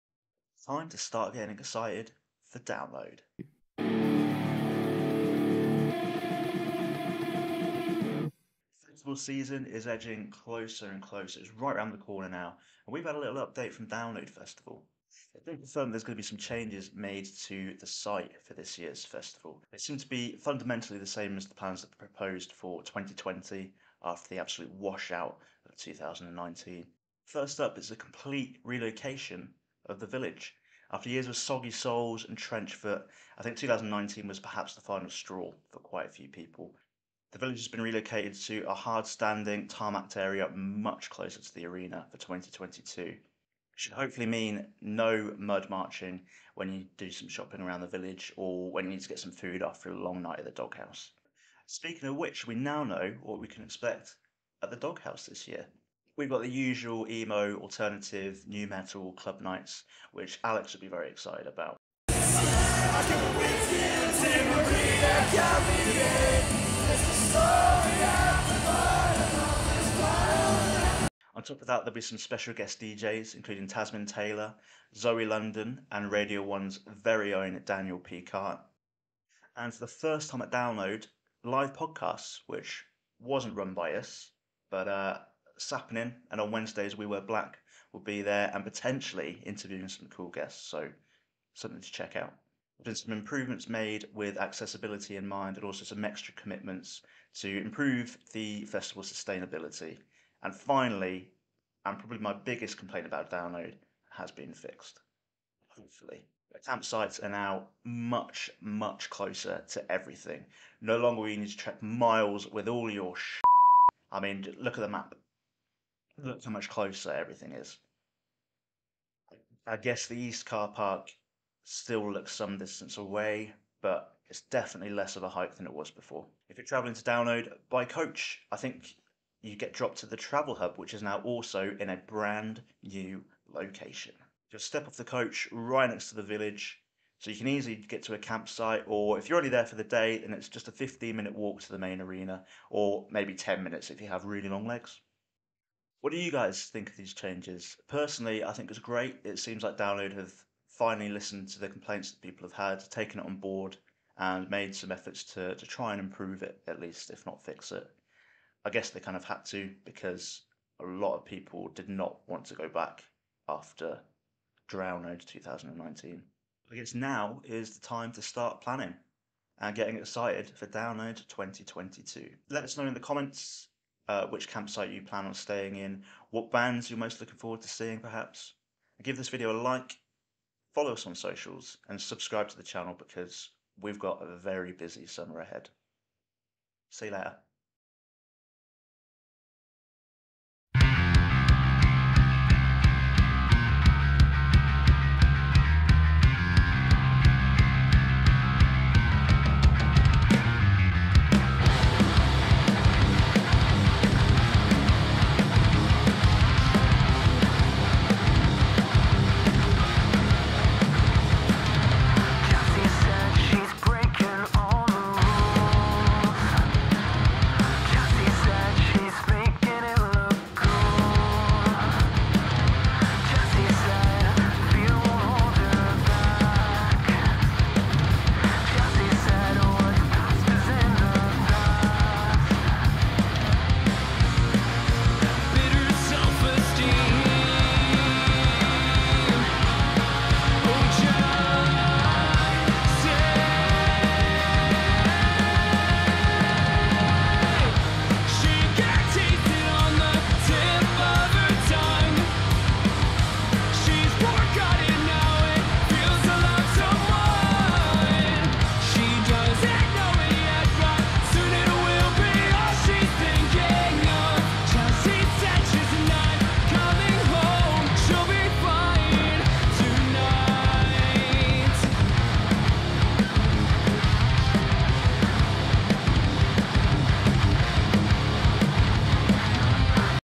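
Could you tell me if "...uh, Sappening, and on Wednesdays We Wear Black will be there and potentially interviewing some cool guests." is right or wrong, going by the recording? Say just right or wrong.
right.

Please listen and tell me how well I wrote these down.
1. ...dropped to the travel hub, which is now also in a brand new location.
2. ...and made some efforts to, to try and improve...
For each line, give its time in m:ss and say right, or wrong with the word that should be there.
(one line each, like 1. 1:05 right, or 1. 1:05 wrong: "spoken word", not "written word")
1. 2:09 right
2. 2:34 right.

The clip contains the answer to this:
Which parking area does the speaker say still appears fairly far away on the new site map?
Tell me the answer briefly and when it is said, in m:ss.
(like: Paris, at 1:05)
east car park, at 2:00.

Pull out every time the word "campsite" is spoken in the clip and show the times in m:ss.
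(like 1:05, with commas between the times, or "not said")
1:46, 2:18, 2:54.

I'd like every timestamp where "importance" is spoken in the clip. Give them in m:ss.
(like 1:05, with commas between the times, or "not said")
not said.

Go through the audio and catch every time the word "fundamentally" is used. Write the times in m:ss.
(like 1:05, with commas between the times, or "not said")
0:20.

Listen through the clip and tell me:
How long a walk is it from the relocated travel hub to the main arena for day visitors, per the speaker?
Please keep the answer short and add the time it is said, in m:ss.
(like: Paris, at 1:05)
15 minutes, at 2:20.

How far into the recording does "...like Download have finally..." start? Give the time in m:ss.
2:29.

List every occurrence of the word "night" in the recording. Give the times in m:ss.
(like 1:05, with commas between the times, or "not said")
0:50, 0:59.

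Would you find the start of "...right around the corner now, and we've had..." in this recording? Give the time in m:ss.
0:11.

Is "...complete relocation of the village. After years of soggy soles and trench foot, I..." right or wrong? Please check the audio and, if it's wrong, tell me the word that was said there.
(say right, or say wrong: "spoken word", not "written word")
right.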